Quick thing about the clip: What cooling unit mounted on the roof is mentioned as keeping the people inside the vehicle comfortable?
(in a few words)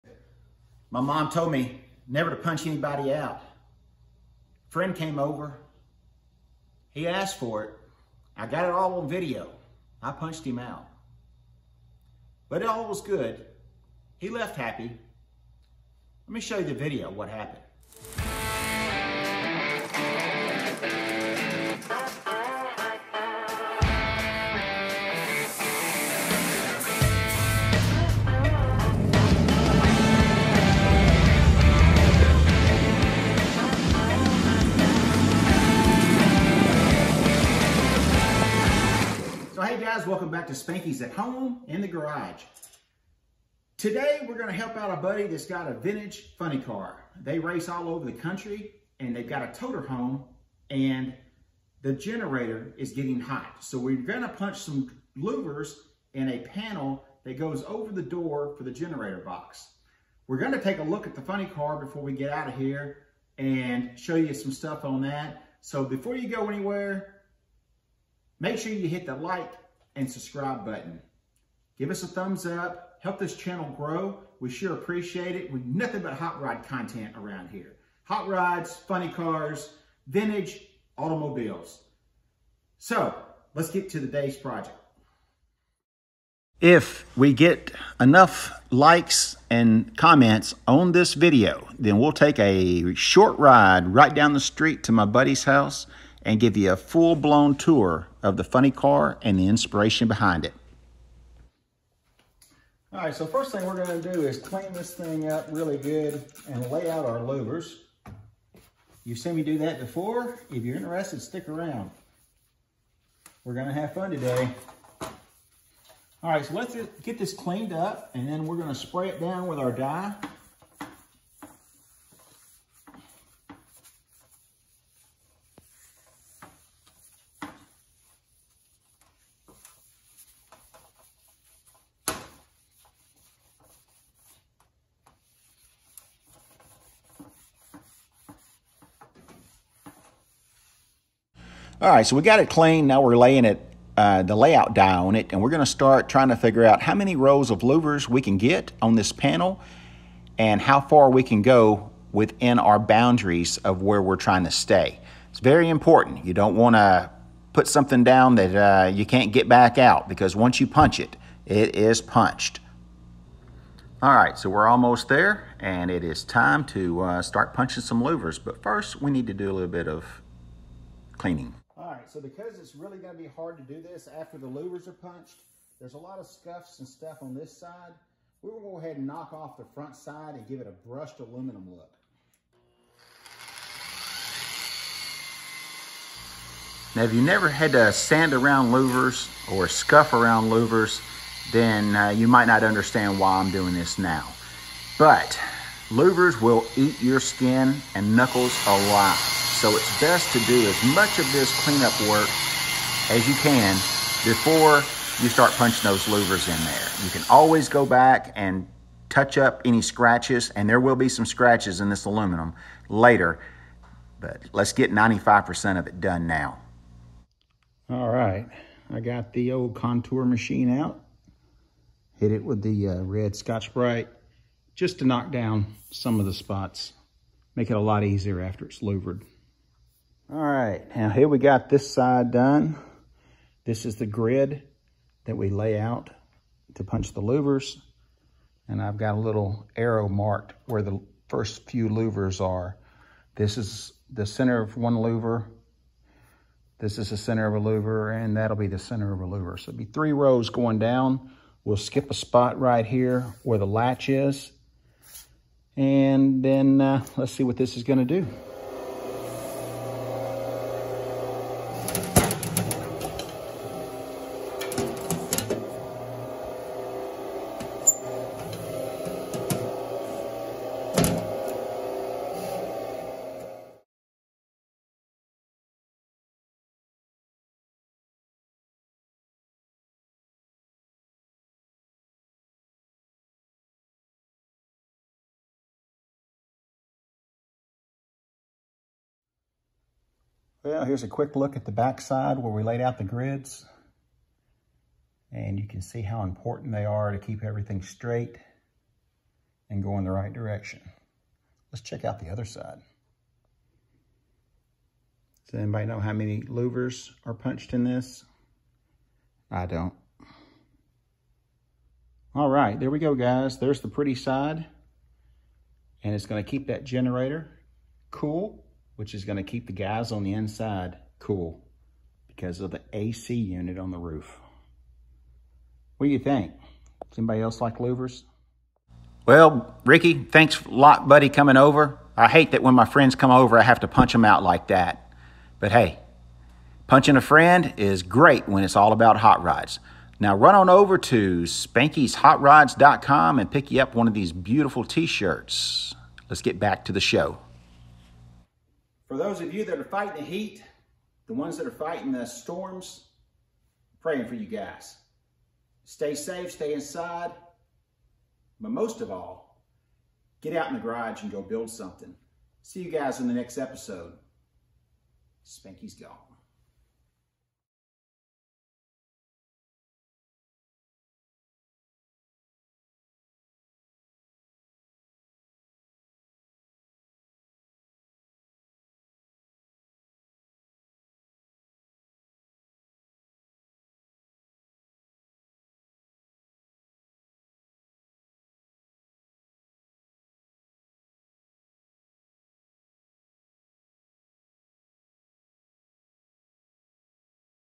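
AC unit.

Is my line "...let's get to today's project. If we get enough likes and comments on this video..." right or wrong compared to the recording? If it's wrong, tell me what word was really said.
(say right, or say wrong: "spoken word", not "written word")
right.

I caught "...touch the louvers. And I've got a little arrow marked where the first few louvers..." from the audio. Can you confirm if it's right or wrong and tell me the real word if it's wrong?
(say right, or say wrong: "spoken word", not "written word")
wrong: "punch", not "touch".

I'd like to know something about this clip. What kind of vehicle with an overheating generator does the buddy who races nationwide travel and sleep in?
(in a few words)
Toter home.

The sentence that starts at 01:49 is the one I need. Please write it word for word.
You've seen me do that before.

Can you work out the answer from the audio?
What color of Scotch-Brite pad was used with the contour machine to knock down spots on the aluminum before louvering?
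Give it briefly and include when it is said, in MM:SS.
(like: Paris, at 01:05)
Red, at 03:43.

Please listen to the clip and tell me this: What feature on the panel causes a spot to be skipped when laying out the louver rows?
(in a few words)
The latch.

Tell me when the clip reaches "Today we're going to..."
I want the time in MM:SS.
00:43.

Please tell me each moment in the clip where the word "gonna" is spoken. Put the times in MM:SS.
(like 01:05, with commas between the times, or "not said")
01:43, 01:53, 01:58, 02:25, 04:17, 05:19.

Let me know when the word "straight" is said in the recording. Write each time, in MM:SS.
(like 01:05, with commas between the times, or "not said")
04:57.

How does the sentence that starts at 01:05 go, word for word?
So before you go anywhere, Make sure you hit the like and subscribe button.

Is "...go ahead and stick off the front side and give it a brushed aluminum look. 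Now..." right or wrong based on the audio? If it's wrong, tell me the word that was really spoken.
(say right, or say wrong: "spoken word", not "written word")
wrong: "knock", not "stick".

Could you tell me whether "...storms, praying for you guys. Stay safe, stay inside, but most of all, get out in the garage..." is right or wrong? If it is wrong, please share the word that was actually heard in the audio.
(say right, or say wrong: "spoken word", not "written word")
right.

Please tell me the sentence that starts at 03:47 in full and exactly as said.
Make it a lot easier after it's louvered.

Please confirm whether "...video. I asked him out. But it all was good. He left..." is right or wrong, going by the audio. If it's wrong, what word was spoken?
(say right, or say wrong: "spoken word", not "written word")
wrong: "punched", not "asked".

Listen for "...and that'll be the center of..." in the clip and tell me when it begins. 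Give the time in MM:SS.
04:08.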